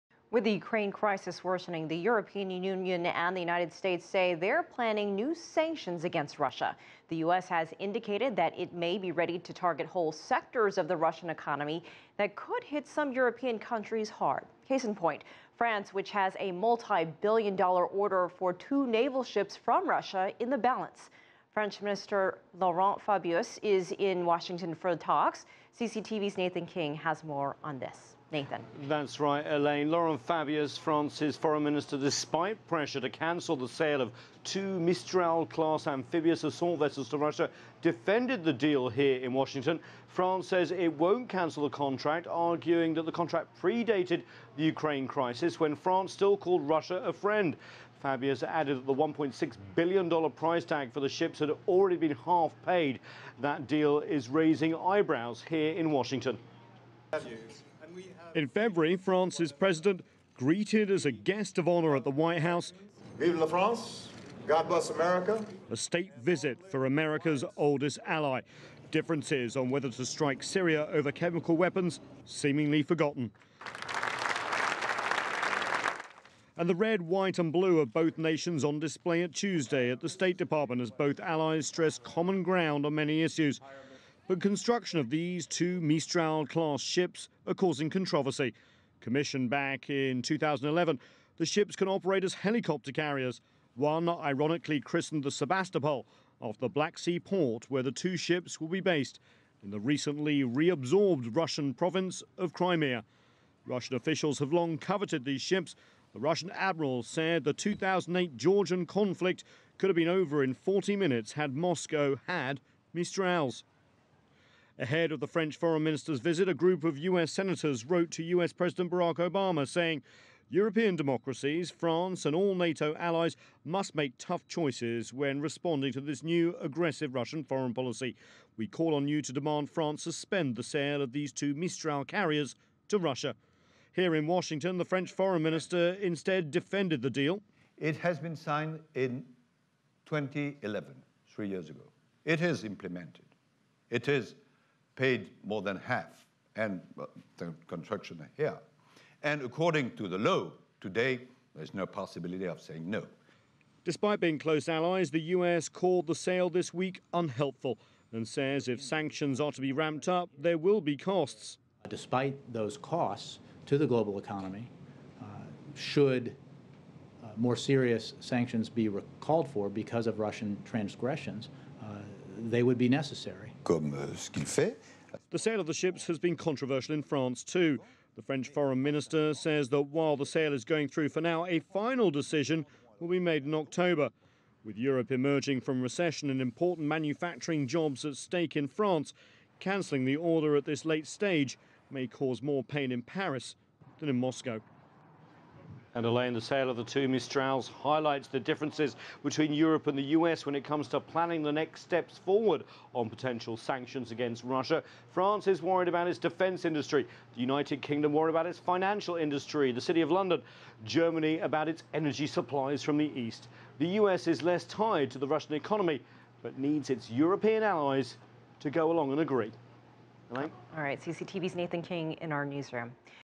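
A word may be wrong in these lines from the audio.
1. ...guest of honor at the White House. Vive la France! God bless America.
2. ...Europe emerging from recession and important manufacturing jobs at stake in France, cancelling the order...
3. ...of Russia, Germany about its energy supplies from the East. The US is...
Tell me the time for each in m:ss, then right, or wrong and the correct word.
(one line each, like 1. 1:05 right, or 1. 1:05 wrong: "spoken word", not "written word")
1. 1:01 right
2. 3:04 right
3. 3:29 wrong: "London", not "Russia".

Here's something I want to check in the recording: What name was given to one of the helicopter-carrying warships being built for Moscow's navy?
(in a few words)
Sebastopol.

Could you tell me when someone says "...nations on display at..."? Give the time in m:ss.
1:18.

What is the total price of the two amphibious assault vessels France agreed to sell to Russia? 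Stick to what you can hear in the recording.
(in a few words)
$1.6 billion.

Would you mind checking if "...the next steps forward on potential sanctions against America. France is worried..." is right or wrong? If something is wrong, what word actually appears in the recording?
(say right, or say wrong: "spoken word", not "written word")
wrong: "Russia", not "America".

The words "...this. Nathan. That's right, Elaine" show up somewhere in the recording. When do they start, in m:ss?
0:27.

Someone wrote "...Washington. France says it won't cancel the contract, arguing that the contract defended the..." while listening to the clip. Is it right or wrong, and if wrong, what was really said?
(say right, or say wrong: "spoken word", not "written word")
wrong: "predated", not "defended".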